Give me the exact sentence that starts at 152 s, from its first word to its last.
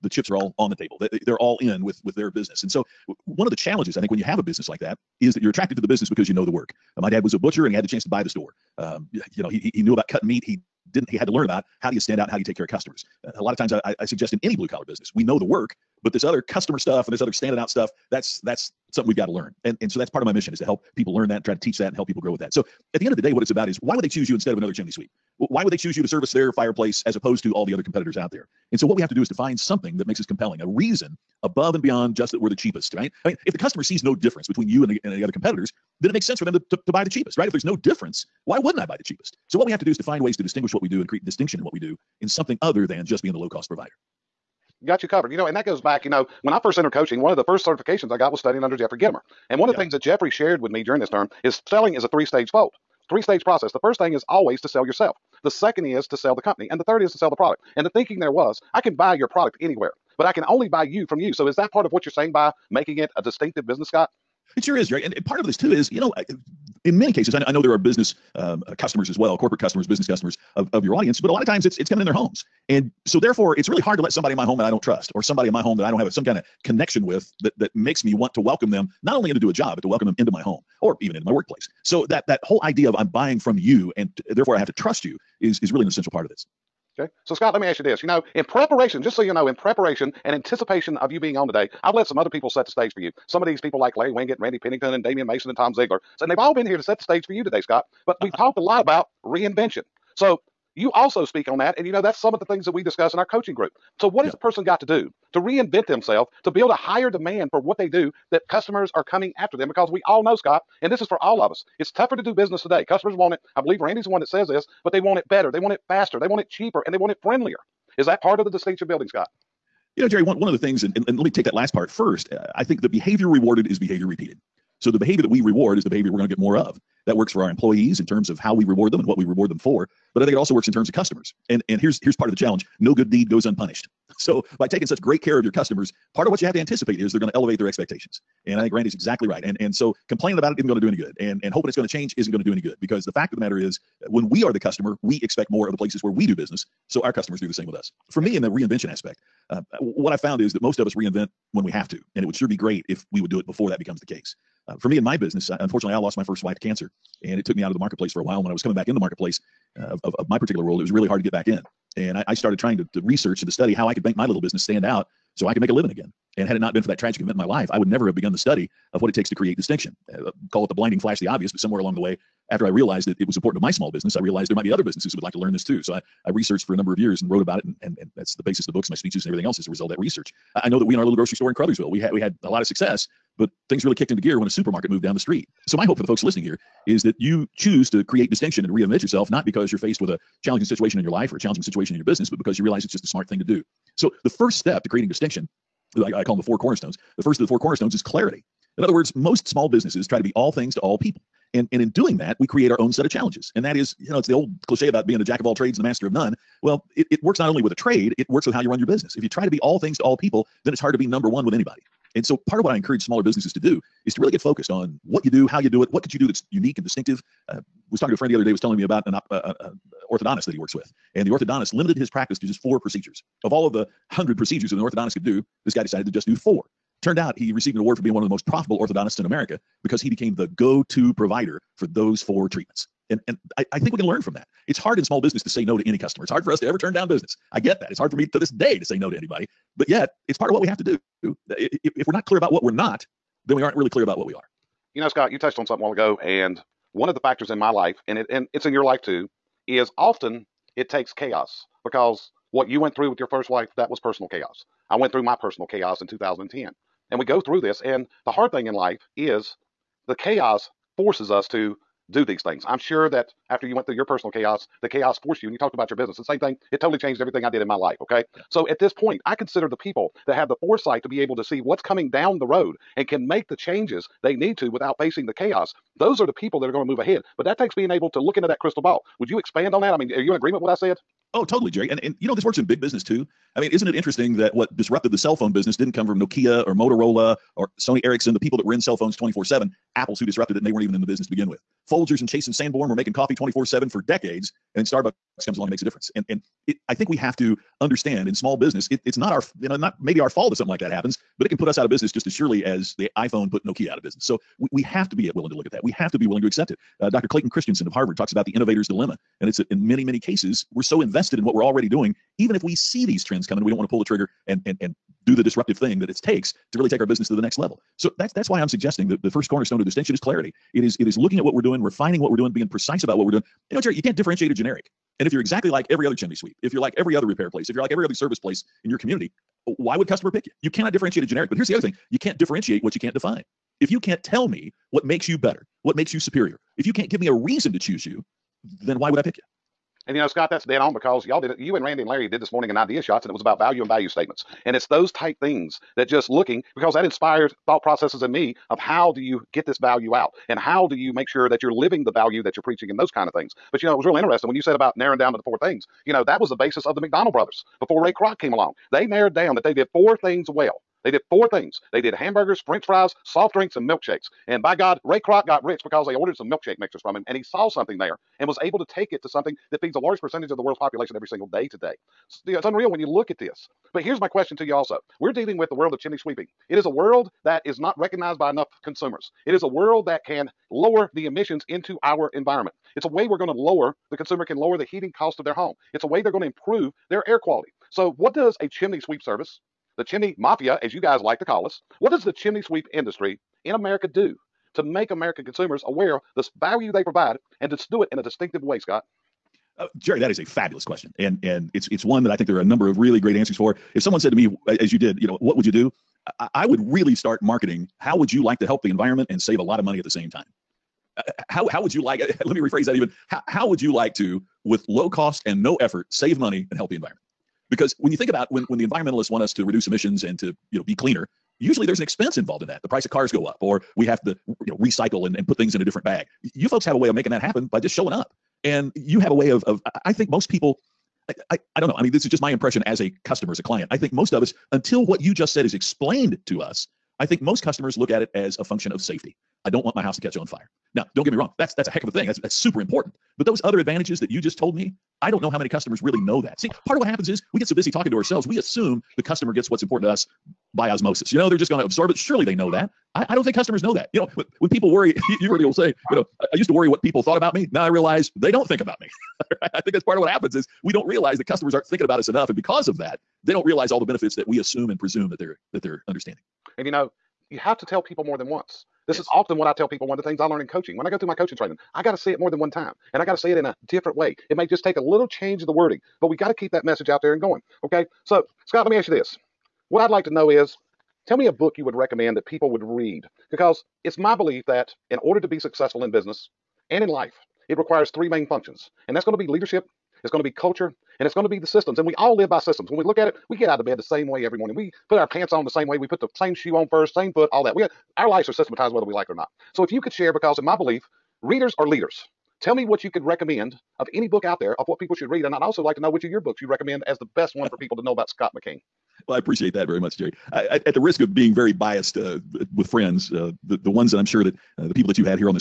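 And it would sure be great if we would do it before that becomes the case.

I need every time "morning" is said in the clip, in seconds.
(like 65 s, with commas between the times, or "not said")
342 s, 494 s.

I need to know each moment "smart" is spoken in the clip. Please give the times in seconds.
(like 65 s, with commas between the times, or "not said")
193 s.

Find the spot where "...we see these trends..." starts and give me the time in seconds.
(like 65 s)
312 s.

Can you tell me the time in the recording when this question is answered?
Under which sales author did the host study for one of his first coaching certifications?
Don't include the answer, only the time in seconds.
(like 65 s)
48 s.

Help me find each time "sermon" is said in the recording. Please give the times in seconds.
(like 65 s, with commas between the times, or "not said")
not said.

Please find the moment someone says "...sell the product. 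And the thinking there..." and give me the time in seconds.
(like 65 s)
57 s.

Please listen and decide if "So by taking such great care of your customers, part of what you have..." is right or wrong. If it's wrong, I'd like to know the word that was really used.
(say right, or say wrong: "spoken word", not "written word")
right.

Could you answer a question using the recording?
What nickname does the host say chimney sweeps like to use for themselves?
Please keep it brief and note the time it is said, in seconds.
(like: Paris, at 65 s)
The chimney mafia, at 389 s.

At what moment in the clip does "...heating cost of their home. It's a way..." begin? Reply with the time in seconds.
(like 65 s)
384 s.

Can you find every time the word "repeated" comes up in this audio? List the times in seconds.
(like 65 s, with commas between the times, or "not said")
124 s.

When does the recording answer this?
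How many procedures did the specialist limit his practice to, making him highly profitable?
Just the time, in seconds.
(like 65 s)
222 s.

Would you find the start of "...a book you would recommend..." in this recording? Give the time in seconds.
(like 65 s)
481 s.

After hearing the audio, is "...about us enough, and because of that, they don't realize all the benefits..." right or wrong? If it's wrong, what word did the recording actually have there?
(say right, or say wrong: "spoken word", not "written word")
right.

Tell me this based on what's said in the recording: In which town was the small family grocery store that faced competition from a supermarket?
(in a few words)
Crothersville.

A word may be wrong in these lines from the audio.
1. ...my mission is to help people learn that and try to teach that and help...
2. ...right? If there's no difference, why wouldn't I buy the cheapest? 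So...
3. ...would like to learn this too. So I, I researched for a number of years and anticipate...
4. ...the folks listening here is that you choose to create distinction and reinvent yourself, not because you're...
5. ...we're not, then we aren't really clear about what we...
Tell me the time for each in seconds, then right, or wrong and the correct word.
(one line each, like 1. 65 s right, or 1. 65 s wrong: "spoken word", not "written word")
1. 20 s right
2. 37 s right
3. 175 s wrong: "wrote", not "anticipate"
4. 186 s right
5. 242 s right.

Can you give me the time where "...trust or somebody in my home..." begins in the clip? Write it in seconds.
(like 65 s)
74 s.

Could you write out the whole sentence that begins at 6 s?
Uh, my dad was a butcher and he had the chance to buy the store.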